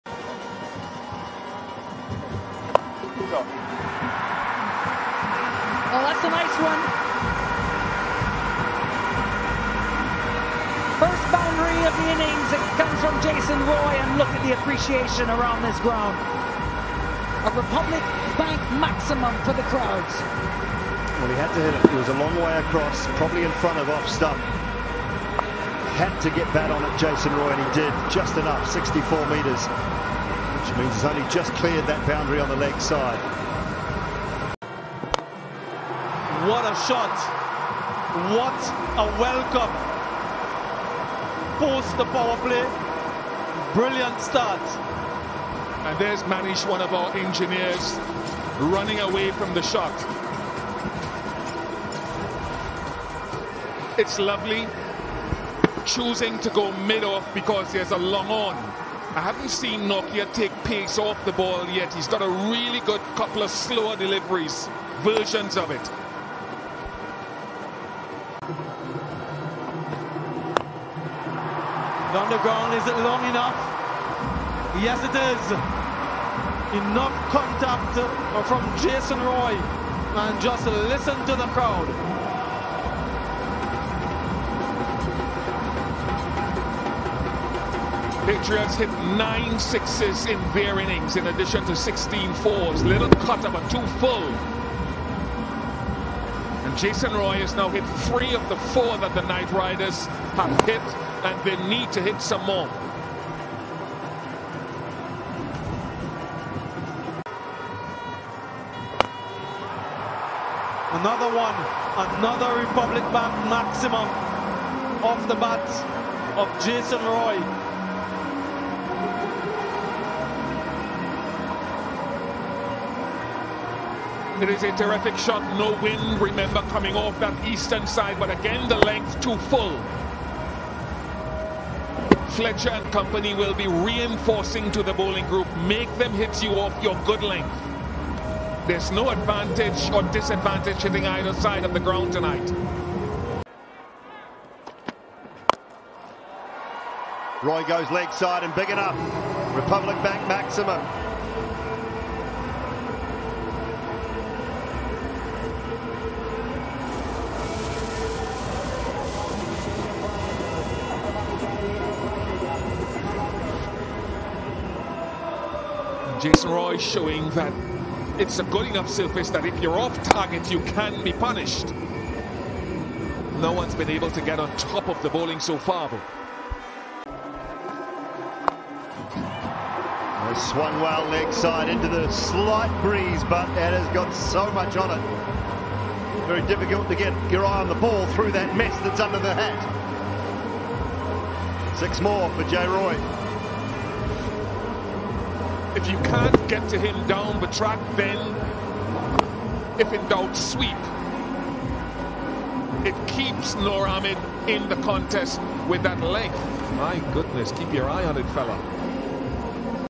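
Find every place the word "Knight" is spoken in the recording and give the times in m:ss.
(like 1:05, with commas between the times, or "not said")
1:39.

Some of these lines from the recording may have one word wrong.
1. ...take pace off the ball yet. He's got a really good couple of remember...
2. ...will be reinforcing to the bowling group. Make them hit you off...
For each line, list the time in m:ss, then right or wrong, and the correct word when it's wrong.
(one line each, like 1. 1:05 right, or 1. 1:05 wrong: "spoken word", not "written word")
1. 1:00 wrong: "slower", not "remember"
2. 2:13 right.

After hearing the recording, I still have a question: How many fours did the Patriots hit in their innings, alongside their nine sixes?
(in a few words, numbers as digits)
16.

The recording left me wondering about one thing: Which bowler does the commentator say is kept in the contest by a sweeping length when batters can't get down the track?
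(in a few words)
Noor Ahmed.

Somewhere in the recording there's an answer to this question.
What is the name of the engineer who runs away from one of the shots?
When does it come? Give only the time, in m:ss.
0:46.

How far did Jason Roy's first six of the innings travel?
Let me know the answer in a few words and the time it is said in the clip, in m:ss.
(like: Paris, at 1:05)
64 metres, at 0:28.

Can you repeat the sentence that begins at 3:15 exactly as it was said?
If you can't get to him down the track, then if in doubt, sweep.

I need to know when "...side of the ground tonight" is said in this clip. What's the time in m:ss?
2:21.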